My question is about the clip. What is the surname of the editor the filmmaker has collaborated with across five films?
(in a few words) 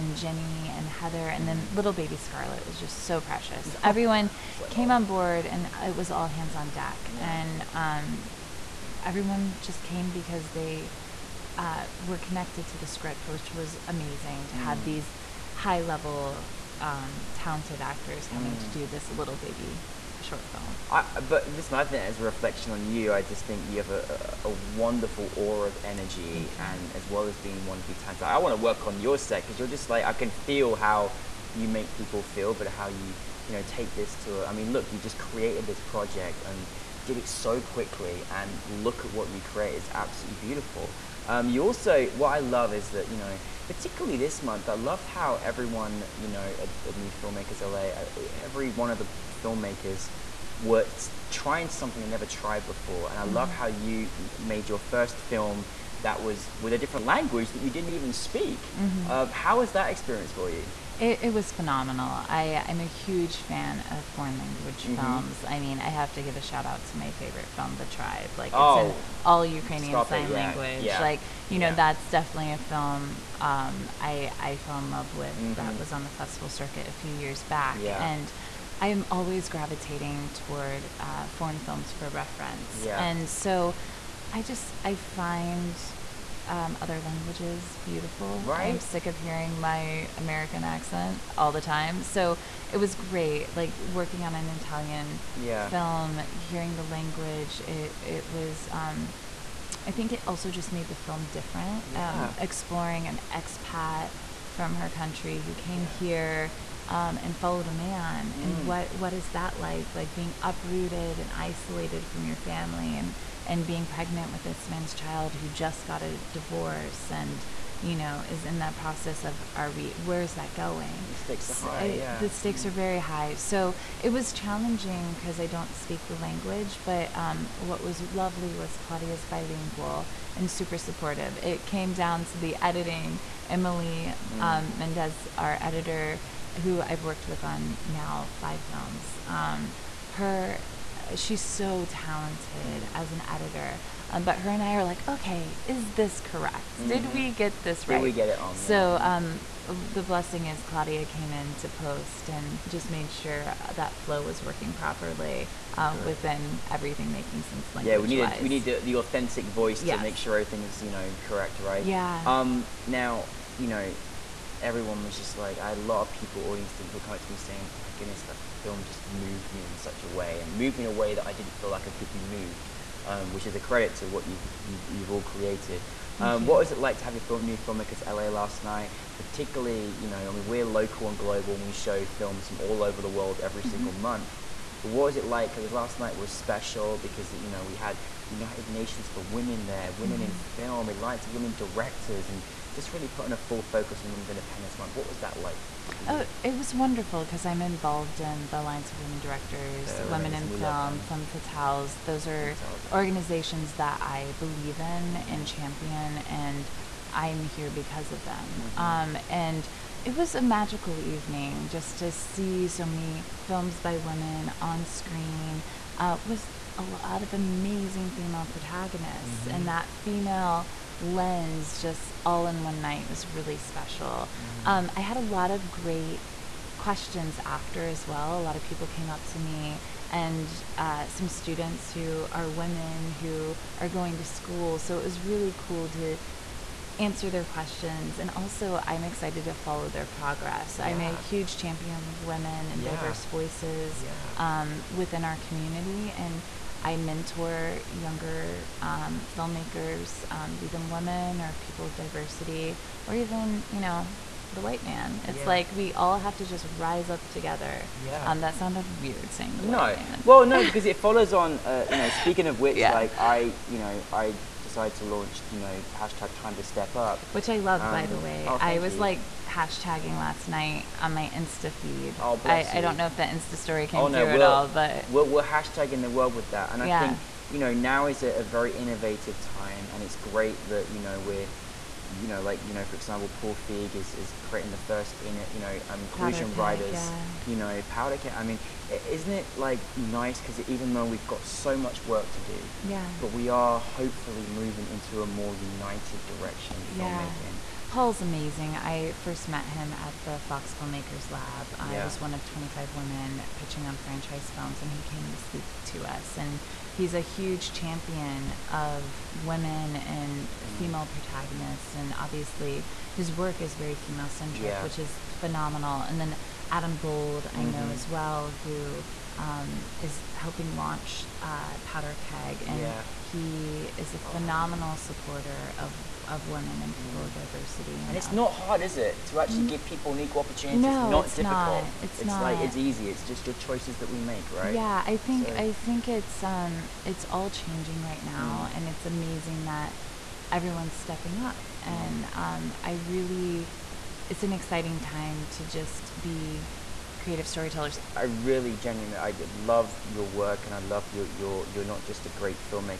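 Mendez.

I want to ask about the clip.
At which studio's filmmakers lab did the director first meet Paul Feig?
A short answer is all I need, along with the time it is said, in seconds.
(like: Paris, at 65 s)
Fox, at 300 s.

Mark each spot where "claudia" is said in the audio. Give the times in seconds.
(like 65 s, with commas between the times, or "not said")
128 s, 150 s.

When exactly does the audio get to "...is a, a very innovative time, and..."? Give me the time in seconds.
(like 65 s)
278 s.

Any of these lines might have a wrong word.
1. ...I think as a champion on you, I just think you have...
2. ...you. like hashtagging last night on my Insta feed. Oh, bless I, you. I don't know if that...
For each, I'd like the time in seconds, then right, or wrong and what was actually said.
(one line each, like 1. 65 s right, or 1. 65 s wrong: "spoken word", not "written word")
1. 21 s wrong: "reflection", not "champion"
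2. 268 s right.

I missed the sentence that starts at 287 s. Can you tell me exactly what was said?
you know, powder I mean, isn't it like nice?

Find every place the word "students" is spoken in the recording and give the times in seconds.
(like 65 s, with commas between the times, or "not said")
231 s.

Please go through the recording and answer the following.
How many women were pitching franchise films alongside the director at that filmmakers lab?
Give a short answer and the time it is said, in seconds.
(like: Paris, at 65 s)
25, at 302 s.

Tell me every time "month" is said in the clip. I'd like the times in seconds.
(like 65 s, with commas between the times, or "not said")
44 s, 183 s, 194 s.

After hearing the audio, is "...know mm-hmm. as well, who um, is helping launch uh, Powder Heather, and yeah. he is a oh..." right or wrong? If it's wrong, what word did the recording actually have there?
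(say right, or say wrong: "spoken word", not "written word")
wrong: "Keg", not "Heather".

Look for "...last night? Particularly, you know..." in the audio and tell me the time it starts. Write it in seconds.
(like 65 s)
178 s.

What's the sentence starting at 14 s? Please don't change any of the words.
have these high level um, talented actors coming mm.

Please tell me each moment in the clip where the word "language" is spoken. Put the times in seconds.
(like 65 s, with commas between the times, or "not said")
57 s, 64 s, 70 s, 86 s, 96 s, 126 s, 157 s.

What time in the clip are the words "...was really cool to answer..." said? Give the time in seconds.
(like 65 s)
235 s.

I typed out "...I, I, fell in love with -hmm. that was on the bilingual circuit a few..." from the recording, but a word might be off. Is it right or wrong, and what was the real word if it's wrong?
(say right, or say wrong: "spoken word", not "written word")
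wrong: "festival", not "bilingual".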